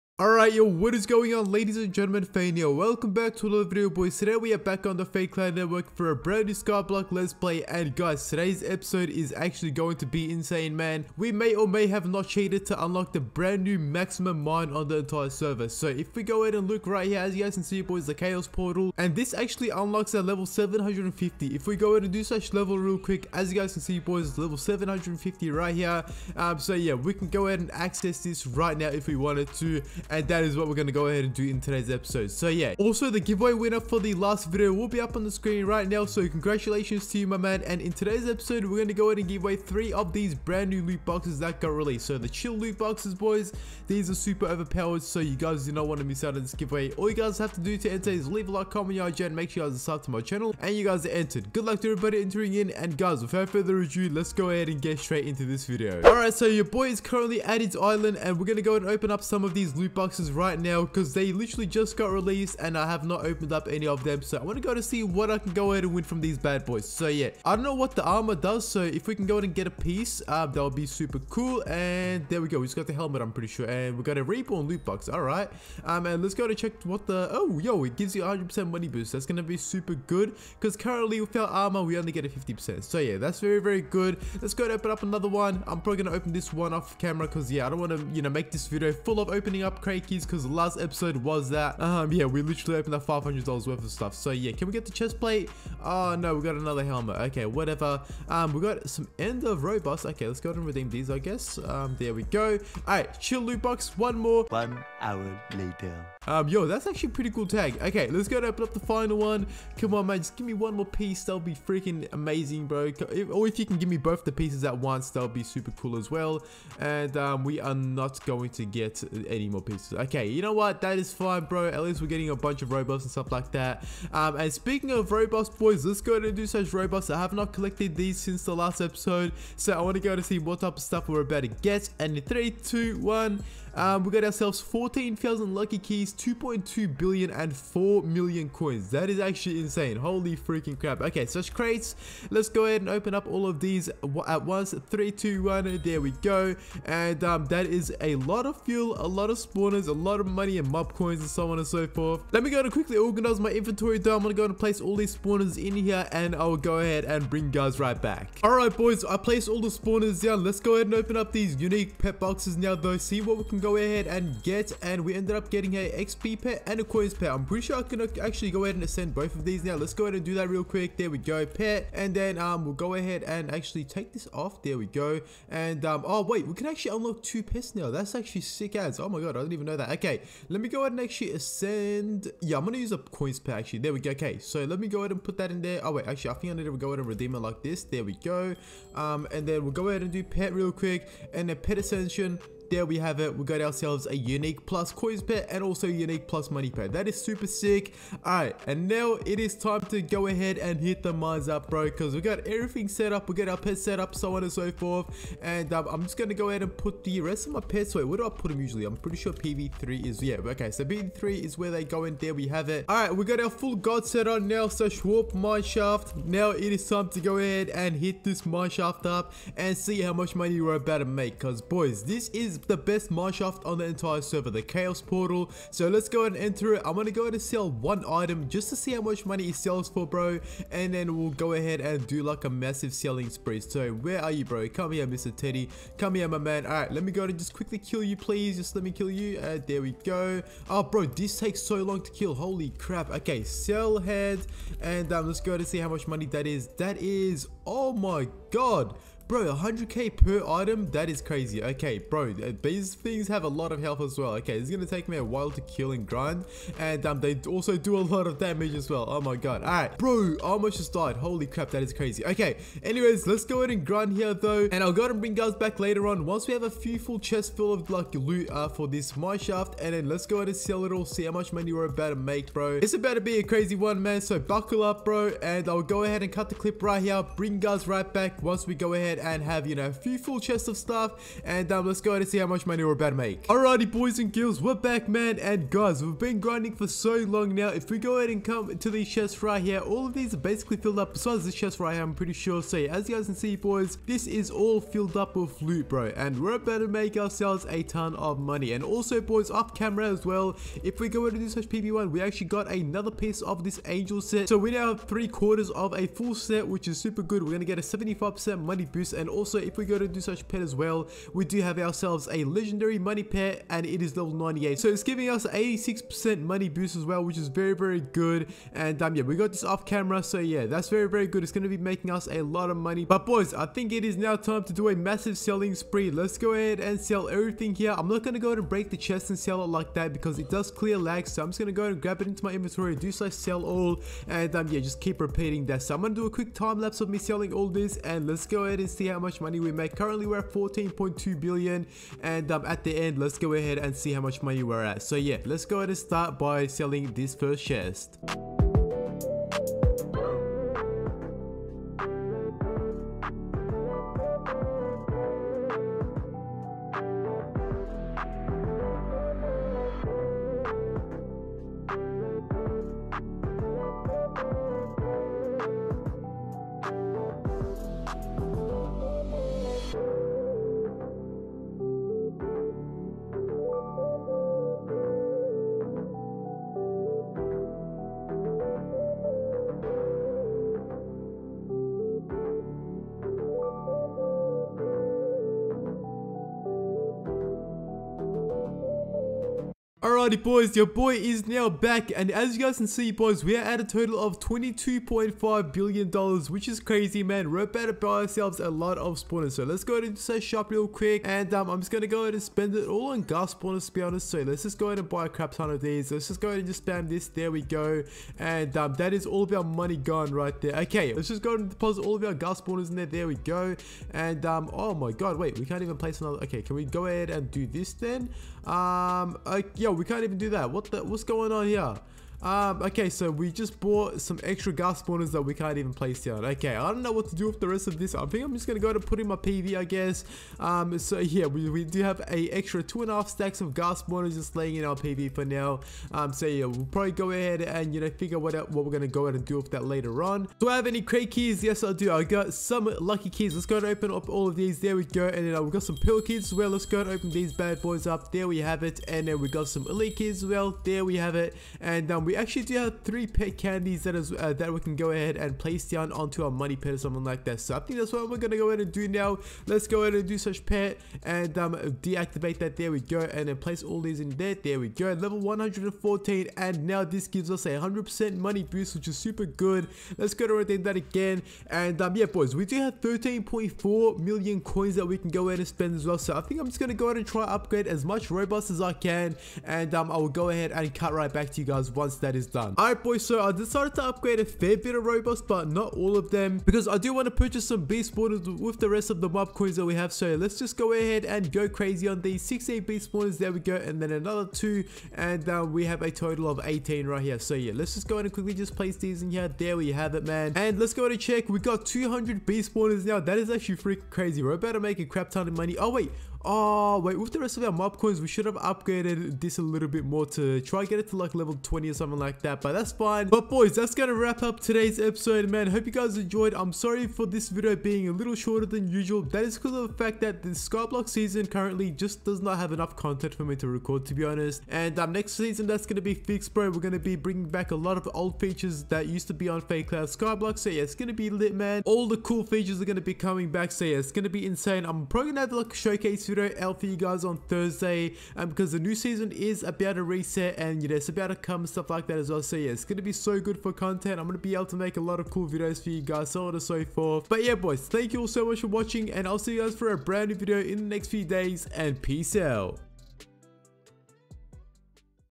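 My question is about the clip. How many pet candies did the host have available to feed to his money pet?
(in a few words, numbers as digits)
3.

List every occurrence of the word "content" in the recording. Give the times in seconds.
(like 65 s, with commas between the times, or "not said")
522 s, 543 s.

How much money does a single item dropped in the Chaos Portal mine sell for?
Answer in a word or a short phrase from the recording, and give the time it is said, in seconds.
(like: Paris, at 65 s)
100k, at 249 s.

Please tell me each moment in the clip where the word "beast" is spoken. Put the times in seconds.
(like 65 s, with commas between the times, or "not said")
487 s, 492 s, 502 s.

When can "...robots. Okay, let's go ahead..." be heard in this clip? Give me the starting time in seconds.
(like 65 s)
99 s.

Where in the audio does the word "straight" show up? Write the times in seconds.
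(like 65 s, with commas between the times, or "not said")
54 s.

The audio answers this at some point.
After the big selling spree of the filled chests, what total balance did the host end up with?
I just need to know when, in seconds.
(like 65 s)
394 s.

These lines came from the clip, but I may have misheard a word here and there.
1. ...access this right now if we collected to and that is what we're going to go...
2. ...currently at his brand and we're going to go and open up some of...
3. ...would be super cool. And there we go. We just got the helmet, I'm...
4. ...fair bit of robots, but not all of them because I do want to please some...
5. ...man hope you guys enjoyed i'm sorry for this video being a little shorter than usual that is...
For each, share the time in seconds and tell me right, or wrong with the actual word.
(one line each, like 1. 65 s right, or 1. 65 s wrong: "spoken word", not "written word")
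1. 27 s wrong: "wanted", not "collected"
2. 56 s wrong: "island", not "brand"
3. 70 s right
4. 484 s wrong: "purchase", not "please"
5. 515 s right.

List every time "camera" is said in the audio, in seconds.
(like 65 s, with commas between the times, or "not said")
86 s, 299 s, 319 s.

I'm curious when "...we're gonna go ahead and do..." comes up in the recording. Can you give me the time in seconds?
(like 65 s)
458 s.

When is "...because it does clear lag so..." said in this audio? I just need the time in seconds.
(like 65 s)
330 s.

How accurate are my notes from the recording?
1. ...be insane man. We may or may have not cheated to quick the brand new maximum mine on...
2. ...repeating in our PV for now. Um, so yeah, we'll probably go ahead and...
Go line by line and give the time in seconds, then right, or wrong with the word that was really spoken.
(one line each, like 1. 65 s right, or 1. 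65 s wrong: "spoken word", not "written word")
1. 10 s wrong: "unlock", not "quick"
2. 434 s wrong: "laying", not "repeating".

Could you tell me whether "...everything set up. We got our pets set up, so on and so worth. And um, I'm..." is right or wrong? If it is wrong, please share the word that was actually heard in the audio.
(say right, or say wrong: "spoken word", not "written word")
wrong: "forth", not "worth".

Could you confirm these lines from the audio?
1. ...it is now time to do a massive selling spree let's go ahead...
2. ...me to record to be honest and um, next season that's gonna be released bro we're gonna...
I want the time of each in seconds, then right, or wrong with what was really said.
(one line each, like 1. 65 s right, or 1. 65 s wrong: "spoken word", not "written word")
1. 323 s right
2. 523 s wrong: "fixed", not "released".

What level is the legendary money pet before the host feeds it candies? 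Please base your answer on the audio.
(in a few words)
98.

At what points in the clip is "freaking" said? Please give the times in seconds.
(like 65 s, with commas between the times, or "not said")
111 s, 140 s, 503 s.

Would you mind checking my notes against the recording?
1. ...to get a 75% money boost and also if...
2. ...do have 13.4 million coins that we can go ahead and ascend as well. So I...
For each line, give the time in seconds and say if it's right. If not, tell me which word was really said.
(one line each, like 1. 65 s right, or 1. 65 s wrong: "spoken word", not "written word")
1. 307 s right
2. 472 s wrong: "spend", not "ascend".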